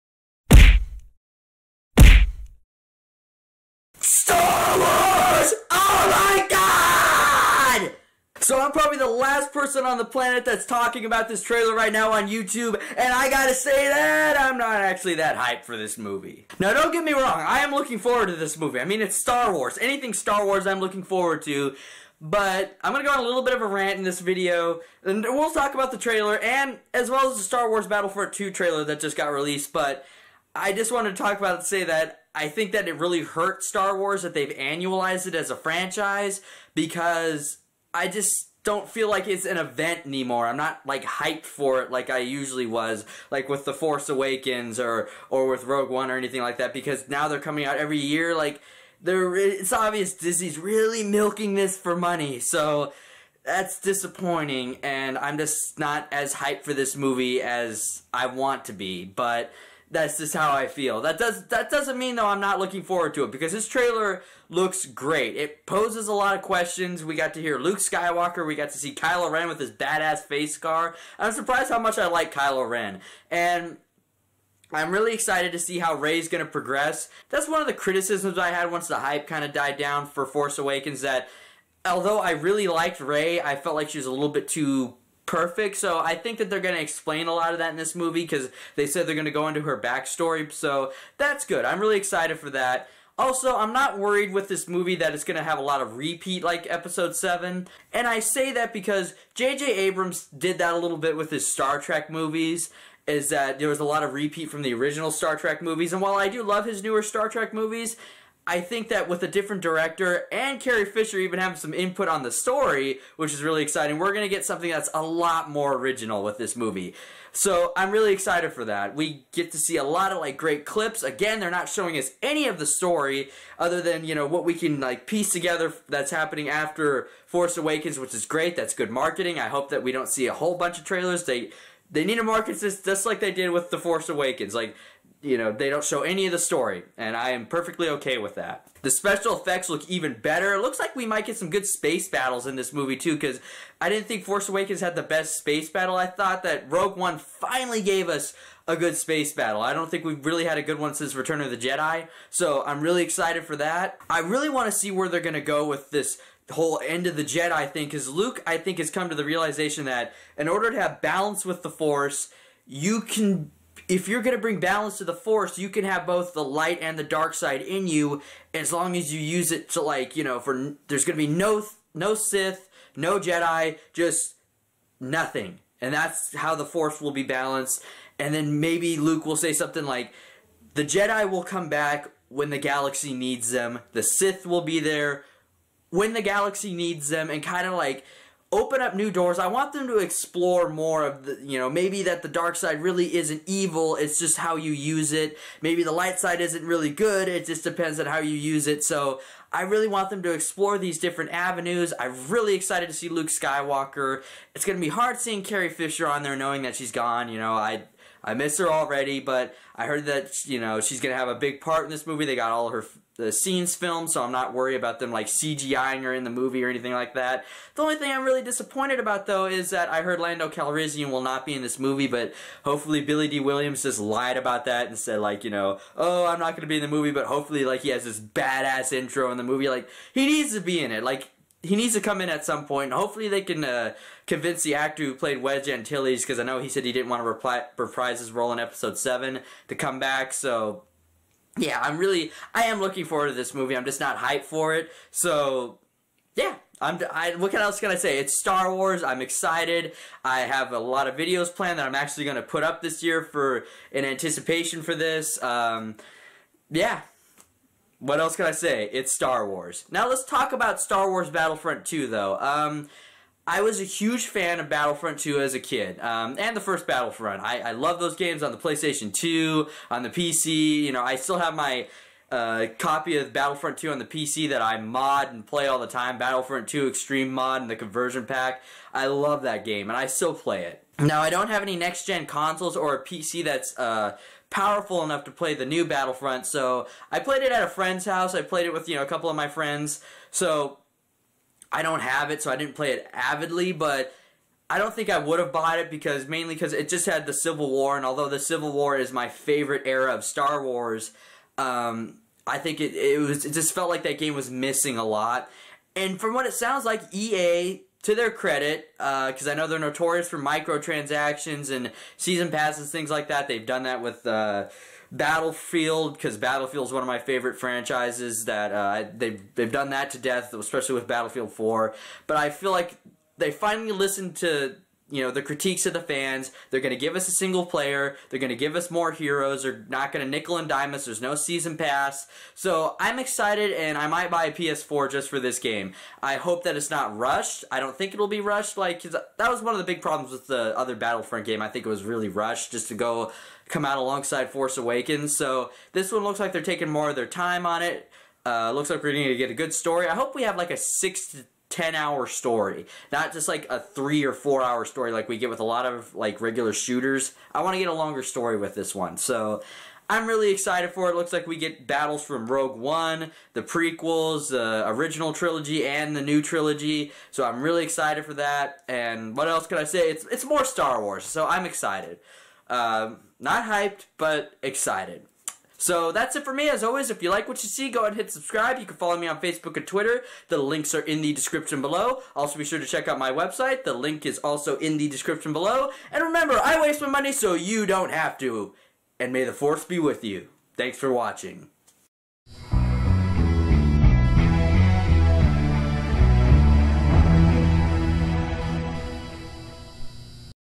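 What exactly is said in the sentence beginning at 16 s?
Now don't get me wrong, I am looking forward to this movie.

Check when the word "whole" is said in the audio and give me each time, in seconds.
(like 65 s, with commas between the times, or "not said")
130 s, 156 s.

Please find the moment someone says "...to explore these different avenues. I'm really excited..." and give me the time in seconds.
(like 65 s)
200 s.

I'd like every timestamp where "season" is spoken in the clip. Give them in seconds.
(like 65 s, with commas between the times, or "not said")
312 s, 331 s.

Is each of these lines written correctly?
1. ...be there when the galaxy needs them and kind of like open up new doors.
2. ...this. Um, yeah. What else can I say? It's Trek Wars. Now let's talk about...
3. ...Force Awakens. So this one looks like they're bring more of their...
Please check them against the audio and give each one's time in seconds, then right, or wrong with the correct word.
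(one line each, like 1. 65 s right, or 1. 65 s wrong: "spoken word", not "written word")
1. 184 s right
2. 254 s wrong: "Star", not "Trek"
3. 344 s wrong: "taking", not "bring".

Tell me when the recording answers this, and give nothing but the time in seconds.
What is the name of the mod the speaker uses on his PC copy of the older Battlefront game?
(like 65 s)
276 s.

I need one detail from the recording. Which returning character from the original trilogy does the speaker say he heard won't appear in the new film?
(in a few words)
Lando Calrissian.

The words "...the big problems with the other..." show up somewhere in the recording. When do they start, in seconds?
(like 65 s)
339 s.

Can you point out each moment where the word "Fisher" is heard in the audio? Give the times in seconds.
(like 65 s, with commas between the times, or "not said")
110 s, 205 s.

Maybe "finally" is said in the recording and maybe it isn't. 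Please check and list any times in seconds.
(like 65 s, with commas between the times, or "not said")
147 s, 323 s.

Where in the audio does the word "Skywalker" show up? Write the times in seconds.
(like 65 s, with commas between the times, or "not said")
67 s, 203 s.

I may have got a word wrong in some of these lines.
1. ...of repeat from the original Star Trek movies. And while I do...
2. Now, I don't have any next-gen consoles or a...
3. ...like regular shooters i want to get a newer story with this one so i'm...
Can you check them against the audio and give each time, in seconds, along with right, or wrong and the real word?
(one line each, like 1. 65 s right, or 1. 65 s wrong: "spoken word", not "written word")
1. 104 s right
2. 280 s right
3. 356 s wrong: "longer", not "newer".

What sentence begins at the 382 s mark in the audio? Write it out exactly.
Also, be sure to check out my website.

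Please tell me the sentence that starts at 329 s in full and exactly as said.
They're not going to nickel and dime us.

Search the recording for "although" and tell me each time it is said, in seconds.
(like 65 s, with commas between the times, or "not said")
81 s, 298 s.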